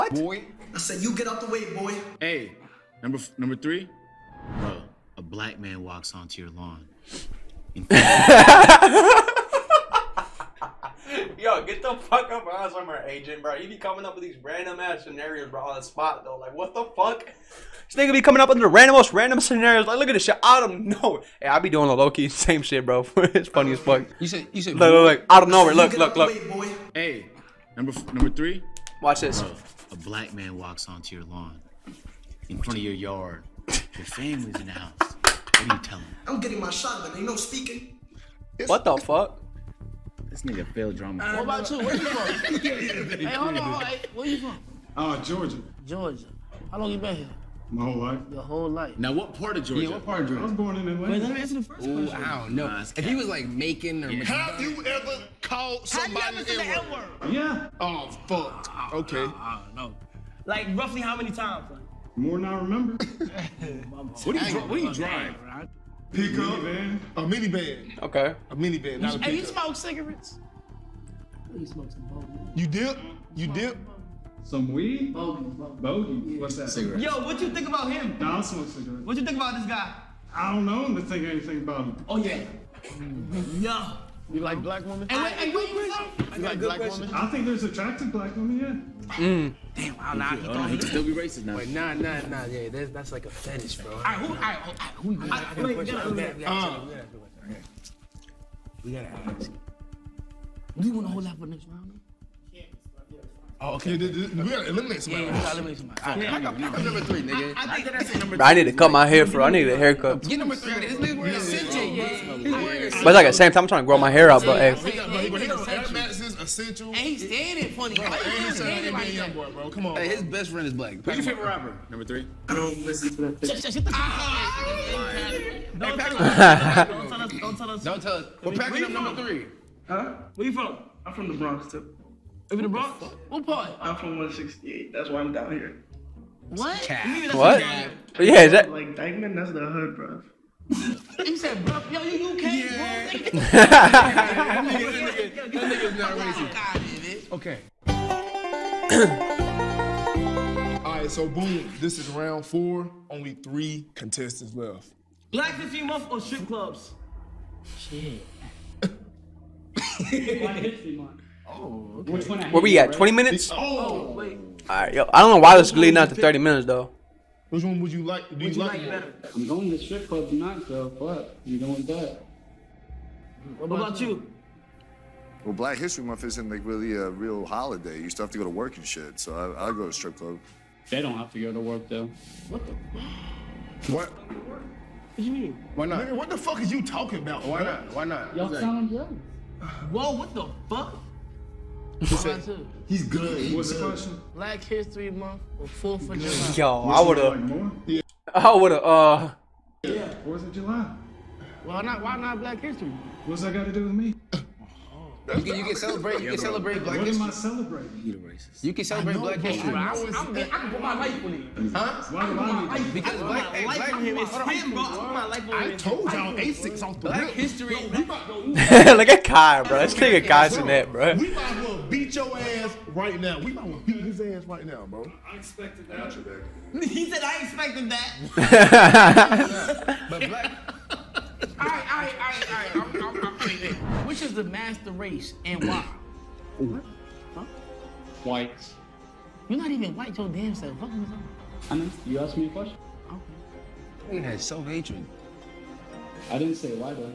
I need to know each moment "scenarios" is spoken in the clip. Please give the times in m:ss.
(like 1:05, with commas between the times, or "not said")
0:15, 0:19.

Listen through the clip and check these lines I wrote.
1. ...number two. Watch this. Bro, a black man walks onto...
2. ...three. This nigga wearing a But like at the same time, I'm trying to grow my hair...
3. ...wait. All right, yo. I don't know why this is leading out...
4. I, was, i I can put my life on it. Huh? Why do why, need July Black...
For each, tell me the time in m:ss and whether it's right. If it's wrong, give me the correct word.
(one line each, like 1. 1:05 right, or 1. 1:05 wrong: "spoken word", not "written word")
1. 0:28 wrong: "three", not "two"
2. 1:50 right
3. 2:44 right
4. 3:29 wrong: "Because", not "July".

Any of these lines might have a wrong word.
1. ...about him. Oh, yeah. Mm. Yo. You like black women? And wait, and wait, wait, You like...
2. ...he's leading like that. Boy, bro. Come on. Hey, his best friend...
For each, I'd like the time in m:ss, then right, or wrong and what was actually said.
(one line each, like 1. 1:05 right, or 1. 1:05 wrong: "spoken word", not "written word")
1. 1:21 right
2. 1:58 wrong: "standing", not "leading".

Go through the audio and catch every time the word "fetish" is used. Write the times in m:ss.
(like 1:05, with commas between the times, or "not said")
1:33.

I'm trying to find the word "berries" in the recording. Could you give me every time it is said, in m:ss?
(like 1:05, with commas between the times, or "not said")
not said.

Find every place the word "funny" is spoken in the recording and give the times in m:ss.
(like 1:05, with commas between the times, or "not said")
0:23, 1:57.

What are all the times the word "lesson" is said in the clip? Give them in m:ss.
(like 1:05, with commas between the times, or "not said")
not said.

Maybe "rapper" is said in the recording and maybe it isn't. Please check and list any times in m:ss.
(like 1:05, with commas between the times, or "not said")
2:01.